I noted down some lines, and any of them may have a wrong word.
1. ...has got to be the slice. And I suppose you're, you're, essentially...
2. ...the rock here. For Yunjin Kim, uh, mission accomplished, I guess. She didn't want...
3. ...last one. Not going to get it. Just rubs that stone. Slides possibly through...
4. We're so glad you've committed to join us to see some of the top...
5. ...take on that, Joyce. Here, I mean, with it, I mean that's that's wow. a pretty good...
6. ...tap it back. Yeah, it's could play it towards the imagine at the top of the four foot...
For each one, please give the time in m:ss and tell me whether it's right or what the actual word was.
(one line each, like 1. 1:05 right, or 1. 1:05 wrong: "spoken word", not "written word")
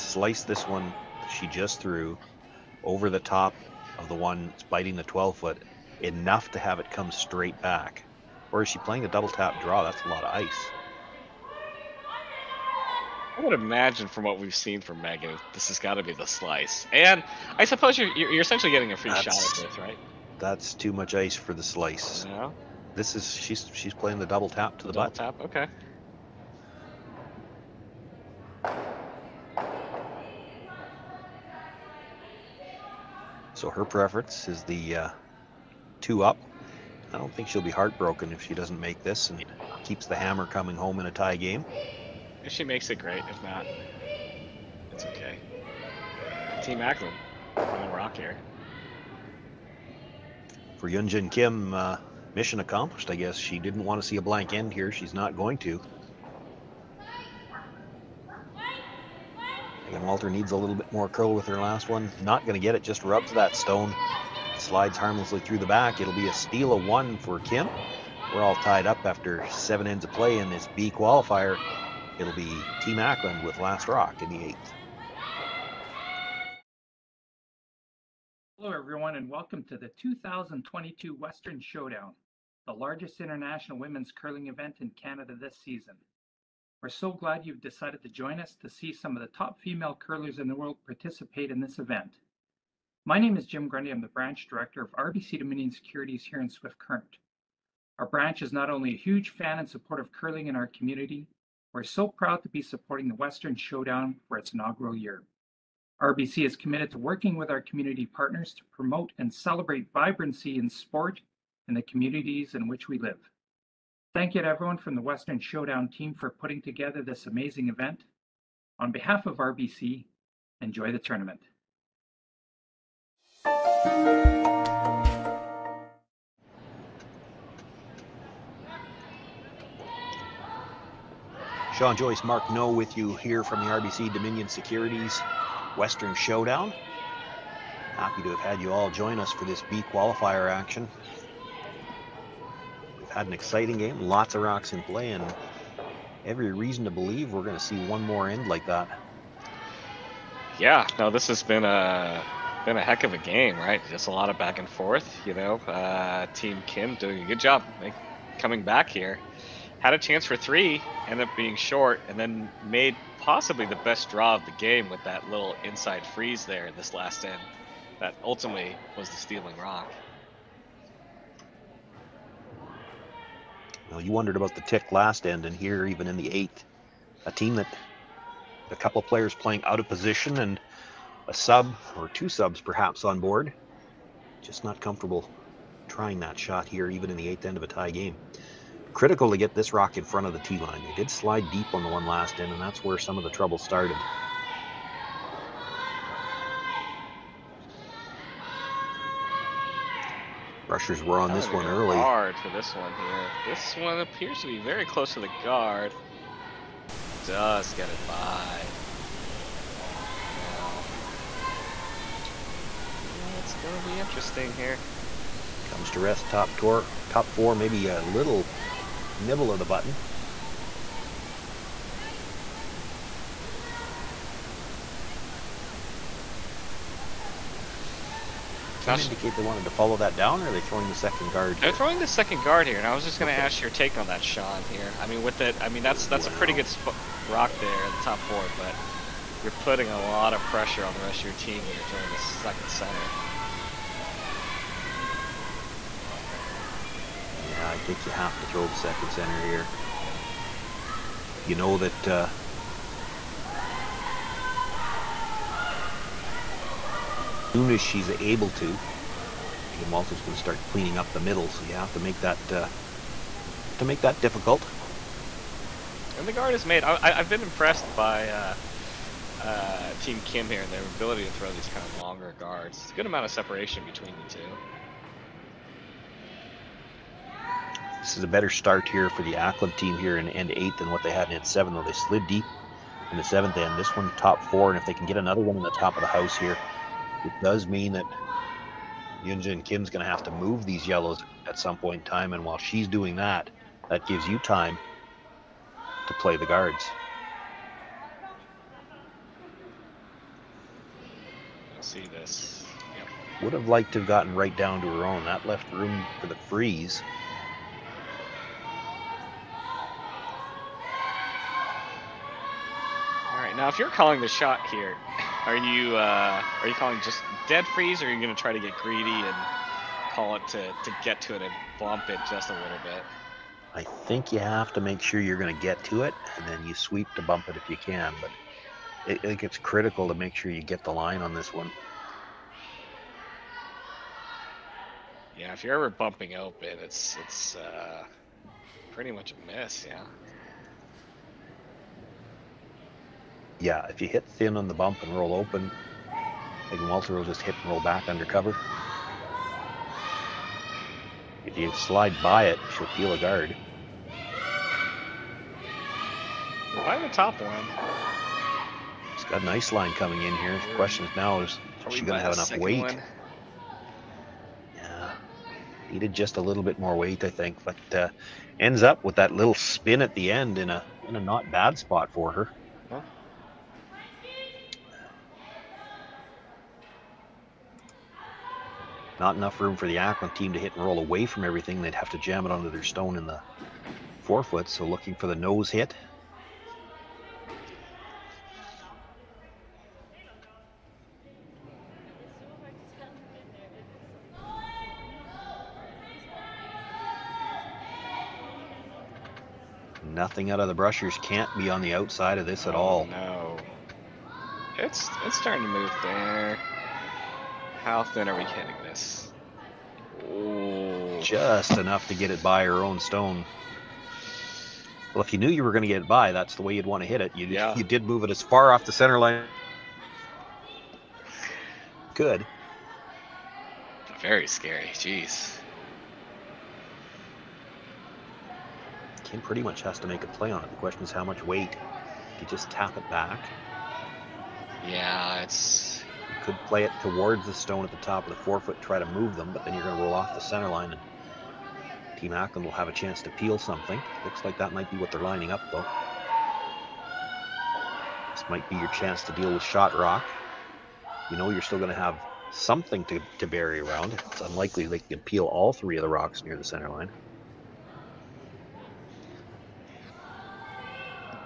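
1. 0:15 right
2. 0:47 right
3. 1:01 wrong: "harmlessly", not "possibly"
4. 1:26 wrong: "decided", not "committed"
5. 3:53 wrong: "Sean", not "Joyce"
6. 7:12 wrong: "stone", not "imagine".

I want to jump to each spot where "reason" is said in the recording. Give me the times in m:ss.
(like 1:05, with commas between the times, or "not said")
2:26.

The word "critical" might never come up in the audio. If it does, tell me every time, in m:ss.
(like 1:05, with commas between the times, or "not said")
3:08, 5:29.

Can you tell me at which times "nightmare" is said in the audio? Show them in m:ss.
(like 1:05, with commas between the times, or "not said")
not said.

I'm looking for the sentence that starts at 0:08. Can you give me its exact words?
Or is she playing a double tap draw?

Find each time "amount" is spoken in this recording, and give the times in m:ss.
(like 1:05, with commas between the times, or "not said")
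4:33.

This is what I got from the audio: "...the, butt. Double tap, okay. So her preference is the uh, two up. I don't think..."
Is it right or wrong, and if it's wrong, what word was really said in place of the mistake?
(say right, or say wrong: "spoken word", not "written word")
right.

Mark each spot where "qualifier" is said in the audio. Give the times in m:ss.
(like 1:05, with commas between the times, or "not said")
1:10, 2:19.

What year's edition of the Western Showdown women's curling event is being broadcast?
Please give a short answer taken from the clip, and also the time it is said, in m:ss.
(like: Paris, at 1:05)
2022, at 1:20.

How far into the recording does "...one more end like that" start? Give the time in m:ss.
2:27.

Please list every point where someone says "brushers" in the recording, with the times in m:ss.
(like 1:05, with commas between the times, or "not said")
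3:20, 6:40.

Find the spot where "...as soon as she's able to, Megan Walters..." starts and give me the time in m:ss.
4:17.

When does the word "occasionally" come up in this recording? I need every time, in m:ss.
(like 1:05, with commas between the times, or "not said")
not said.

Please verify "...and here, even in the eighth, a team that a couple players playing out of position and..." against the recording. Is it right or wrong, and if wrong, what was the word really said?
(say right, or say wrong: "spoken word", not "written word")
right.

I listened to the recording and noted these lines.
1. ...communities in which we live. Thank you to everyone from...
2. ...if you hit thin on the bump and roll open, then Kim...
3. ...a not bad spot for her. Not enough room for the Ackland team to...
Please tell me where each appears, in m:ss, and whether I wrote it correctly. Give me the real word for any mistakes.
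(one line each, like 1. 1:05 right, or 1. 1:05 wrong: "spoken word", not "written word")
1. 1:51 right
2. 5:43 wrong: "Walter", not "Kim"
3. 6:11 right.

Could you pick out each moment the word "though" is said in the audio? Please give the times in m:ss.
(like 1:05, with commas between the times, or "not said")
4:41, 7:25.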